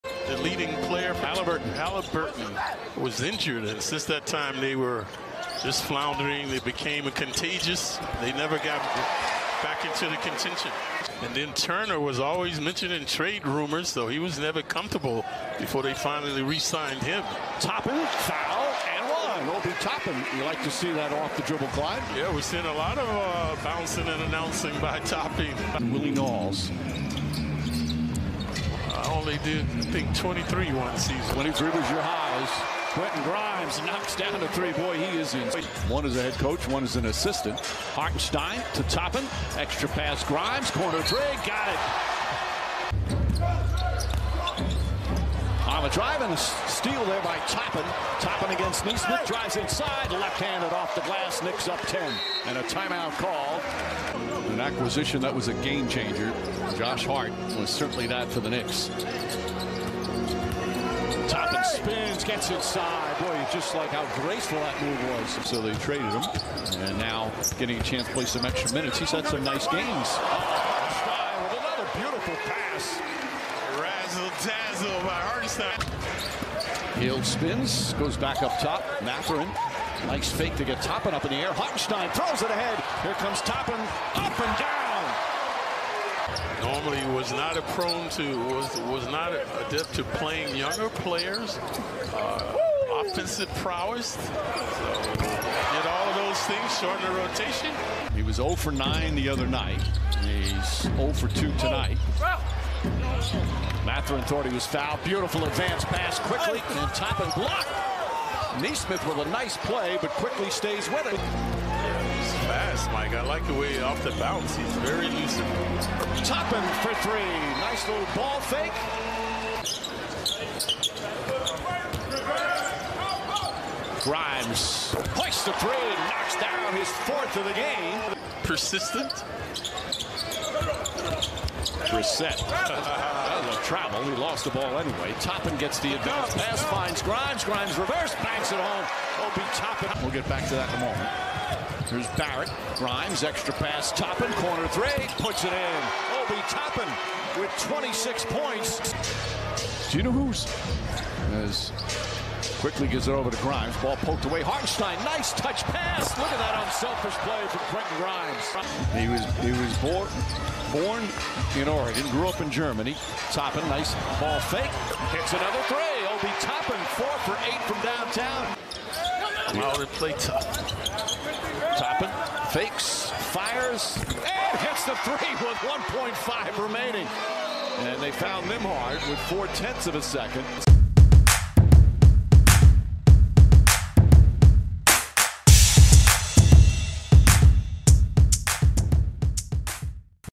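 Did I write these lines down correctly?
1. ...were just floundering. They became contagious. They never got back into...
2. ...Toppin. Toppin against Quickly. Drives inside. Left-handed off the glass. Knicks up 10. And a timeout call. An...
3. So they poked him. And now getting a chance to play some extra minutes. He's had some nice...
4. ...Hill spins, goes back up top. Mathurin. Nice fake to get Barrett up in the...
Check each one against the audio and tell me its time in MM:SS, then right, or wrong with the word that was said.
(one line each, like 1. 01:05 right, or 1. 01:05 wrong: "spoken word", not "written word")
1. 00:04 right
2. 00:47 wrong: "Nesmith", not "Quickly"
3. 01:05 wrong: "traded", not "poked"
4. 01:16 wrong: "Toppin", not "Barrett".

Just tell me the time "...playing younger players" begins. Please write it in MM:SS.
01:30.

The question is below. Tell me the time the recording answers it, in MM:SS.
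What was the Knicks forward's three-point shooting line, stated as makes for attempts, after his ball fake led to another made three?
02:47.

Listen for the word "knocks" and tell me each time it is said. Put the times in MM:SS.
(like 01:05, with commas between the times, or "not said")
00:33, 02:06.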